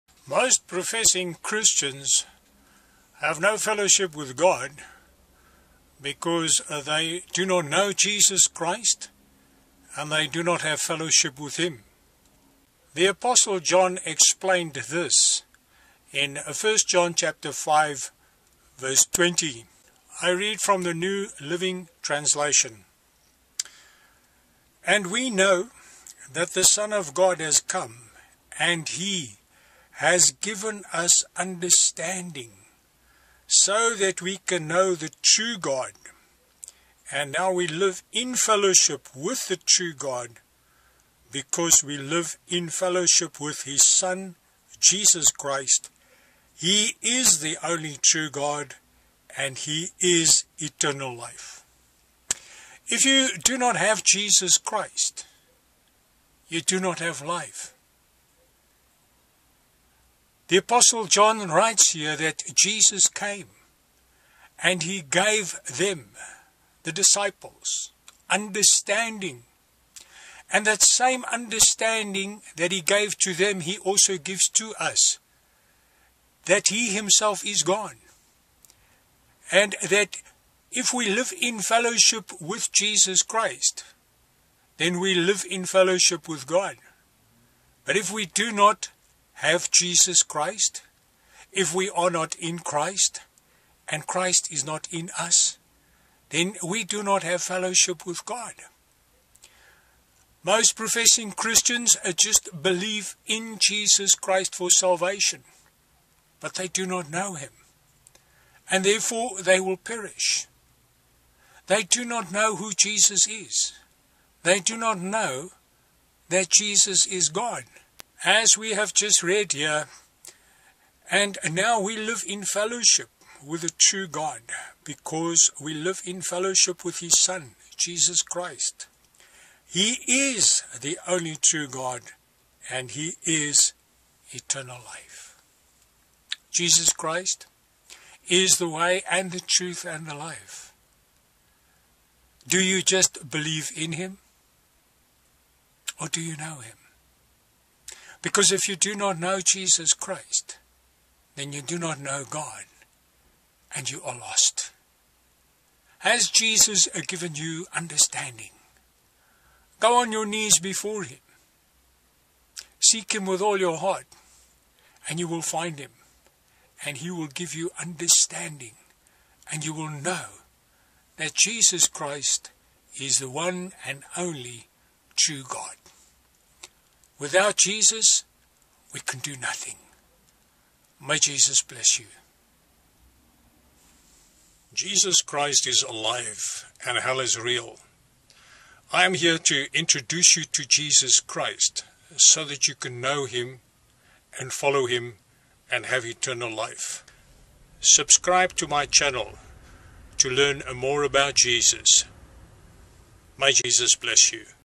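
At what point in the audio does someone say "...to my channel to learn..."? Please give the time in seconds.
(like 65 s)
198 s.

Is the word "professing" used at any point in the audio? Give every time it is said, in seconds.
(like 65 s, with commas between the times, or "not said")
0 s, 100 s.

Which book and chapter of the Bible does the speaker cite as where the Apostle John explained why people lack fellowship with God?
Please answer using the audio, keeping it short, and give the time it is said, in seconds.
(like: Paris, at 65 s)
1 John 5, at 16 s.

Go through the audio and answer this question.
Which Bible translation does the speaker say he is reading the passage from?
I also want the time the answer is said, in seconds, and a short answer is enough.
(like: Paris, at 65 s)
New Living Translation, at 20 s.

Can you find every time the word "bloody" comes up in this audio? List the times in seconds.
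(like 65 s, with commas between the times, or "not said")
not said.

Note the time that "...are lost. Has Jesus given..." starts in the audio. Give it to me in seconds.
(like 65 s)
154 s.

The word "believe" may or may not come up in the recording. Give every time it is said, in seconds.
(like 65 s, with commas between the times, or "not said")
102 s, 143 s.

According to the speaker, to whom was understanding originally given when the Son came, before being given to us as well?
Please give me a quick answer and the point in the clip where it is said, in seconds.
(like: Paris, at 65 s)
the disciples, at 66 s.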